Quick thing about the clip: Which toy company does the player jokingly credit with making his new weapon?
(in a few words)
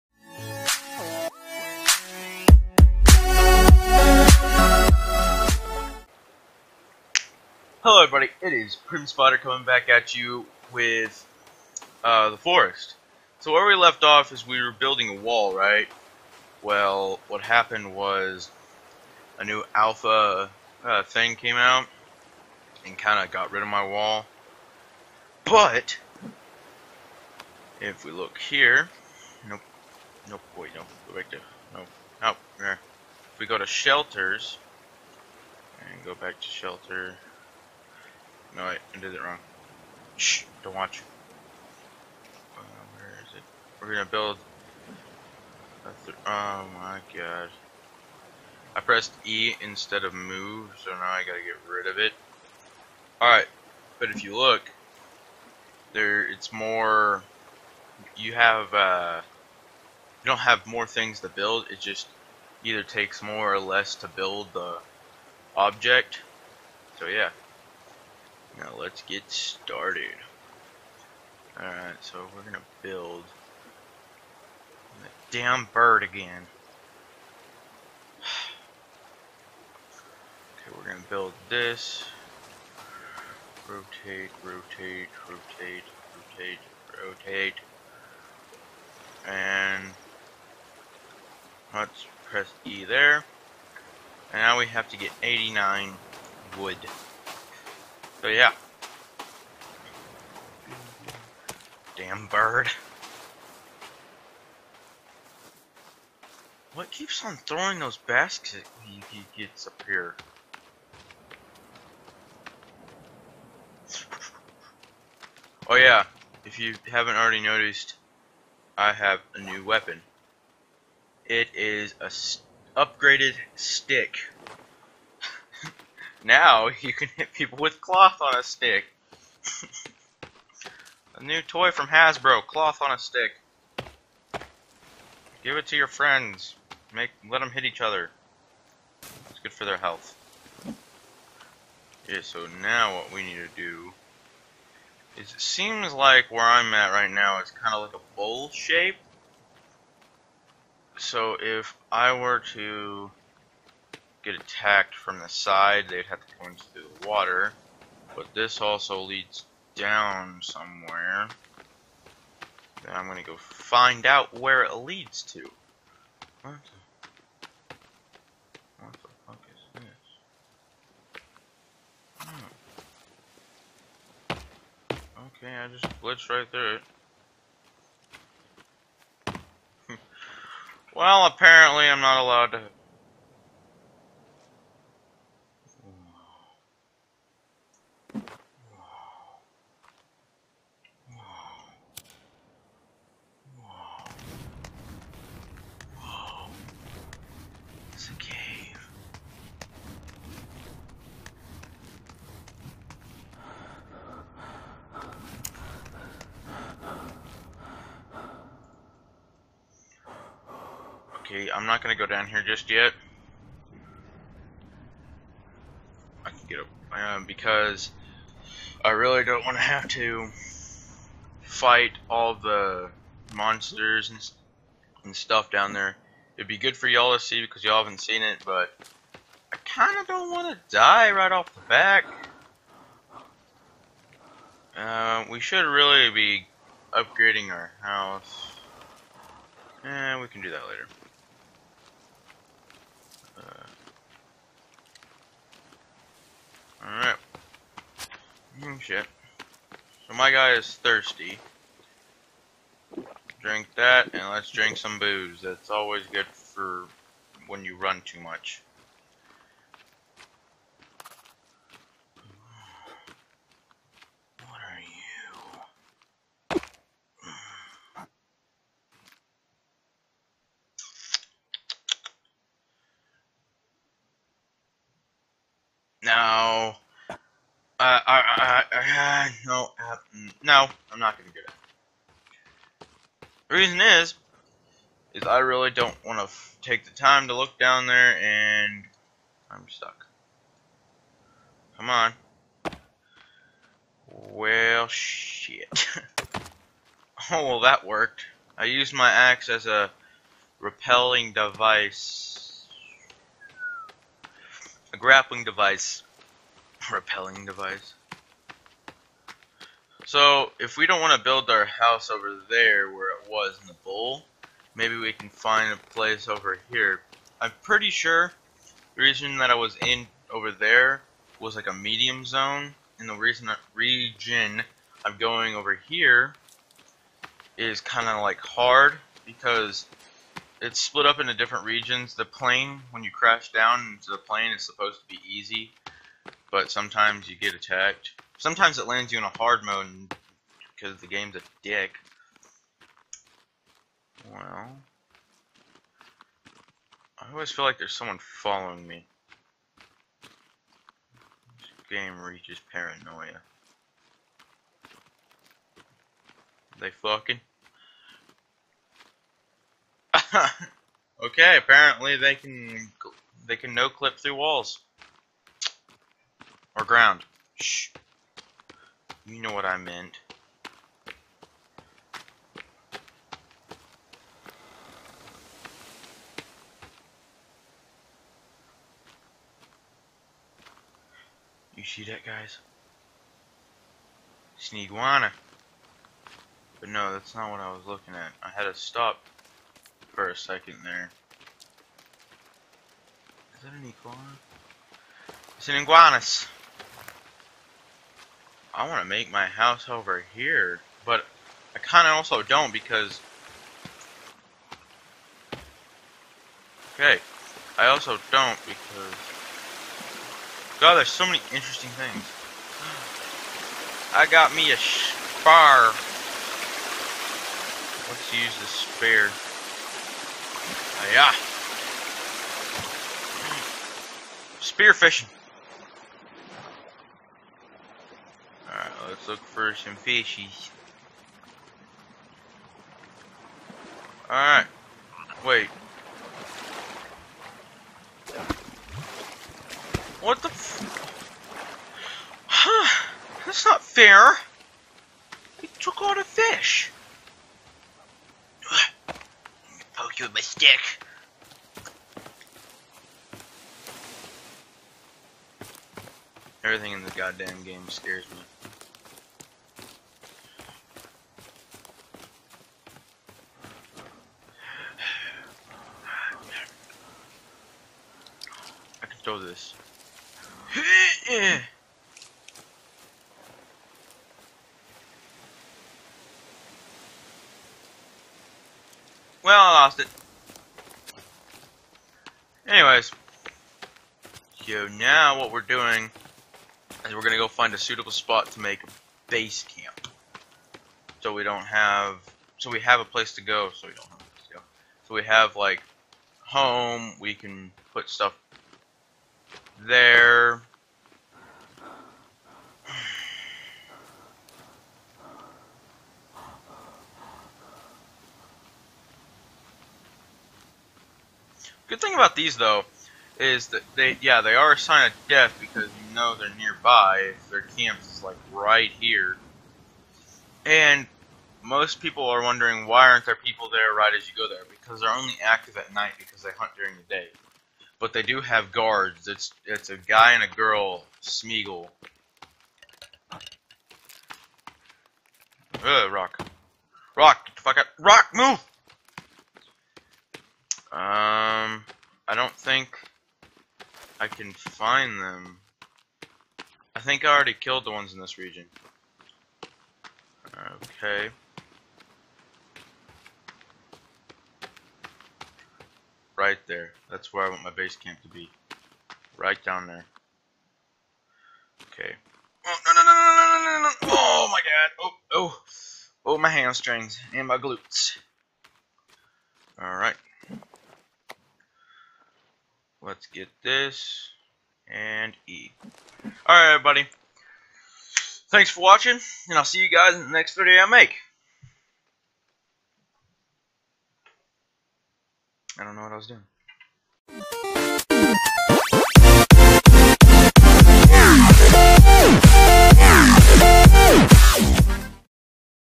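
Hasbro.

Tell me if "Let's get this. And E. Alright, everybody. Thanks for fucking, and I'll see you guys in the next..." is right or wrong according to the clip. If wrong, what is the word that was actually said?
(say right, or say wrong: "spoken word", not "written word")
wrong: "watching", not "fucking".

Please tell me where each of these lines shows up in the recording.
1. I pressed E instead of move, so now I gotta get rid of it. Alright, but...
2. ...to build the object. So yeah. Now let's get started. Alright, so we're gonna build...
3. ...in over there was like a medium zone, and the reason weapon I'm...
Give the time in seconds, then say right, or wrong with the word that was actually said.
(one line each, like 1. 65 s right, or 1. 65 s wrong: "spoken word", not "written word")
1. 48 s right
2. 63 s right
3. 319 s wrong: "region", not "weapon".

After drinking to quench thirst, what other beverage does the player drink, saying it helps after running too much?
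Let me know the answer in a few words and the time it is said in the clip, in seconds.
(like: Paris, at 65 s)
booze, at 254 s.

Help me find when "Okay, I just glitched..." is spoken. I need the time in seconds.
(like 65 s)
175 s.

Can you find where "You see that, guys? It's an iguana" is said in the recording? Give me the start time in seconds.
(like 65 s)
381 s.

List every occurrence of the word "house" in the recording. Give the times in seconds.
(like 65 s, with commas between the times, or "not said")
237 s, 311 s, 399 s.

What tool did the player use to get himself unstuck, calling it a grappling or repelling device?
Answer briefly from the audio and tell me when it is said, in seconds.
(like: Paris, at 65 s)
axe, at 299 s.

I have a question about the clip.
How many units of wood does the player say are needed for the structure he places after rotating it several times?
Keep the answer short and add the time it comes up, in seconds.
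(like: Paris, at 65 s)
89, at 95 s.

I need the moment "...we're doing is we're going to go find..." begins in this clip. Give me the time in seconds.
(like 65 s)
485 s.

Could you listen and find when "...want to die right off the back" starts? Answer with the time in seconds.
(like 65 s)
230 s.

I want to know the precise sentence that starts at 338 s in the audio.
Sometimes it lands you in a hard mode because the game's a dick.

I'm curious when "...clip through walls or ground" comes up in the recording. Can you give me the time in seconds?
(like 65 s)
363 s.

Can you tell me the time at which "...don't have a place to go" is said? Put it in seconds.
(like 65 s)
493 s.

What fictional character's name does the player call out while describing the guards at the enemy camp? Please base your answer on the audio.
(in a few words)
Smeagol.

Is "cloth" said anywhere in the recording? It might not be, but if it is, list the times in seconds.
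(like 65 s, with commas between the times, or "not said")
127 s, 132 s.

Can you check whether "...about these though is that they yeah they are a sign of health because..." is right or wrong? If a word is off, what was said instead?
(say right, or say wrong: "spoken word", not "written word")
wrong: "death", not "health".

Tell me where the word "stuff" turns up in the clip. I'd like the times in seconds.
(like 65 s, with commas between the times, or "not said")
225 s, 498 s.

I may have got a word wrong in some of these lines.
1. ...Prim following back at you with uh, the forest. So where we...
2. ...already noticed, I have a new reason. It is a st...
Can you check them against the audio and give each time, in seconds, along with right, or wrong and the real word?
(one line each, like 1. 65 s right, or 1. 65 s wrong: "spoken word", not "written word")
1. 8 s wrong: "coming", not "following"
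2. 117 s wrong: "weapon", not "reason".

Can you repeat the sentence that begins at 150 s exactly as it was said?
So if I were to get attacked from the side, they'd have to come into the water.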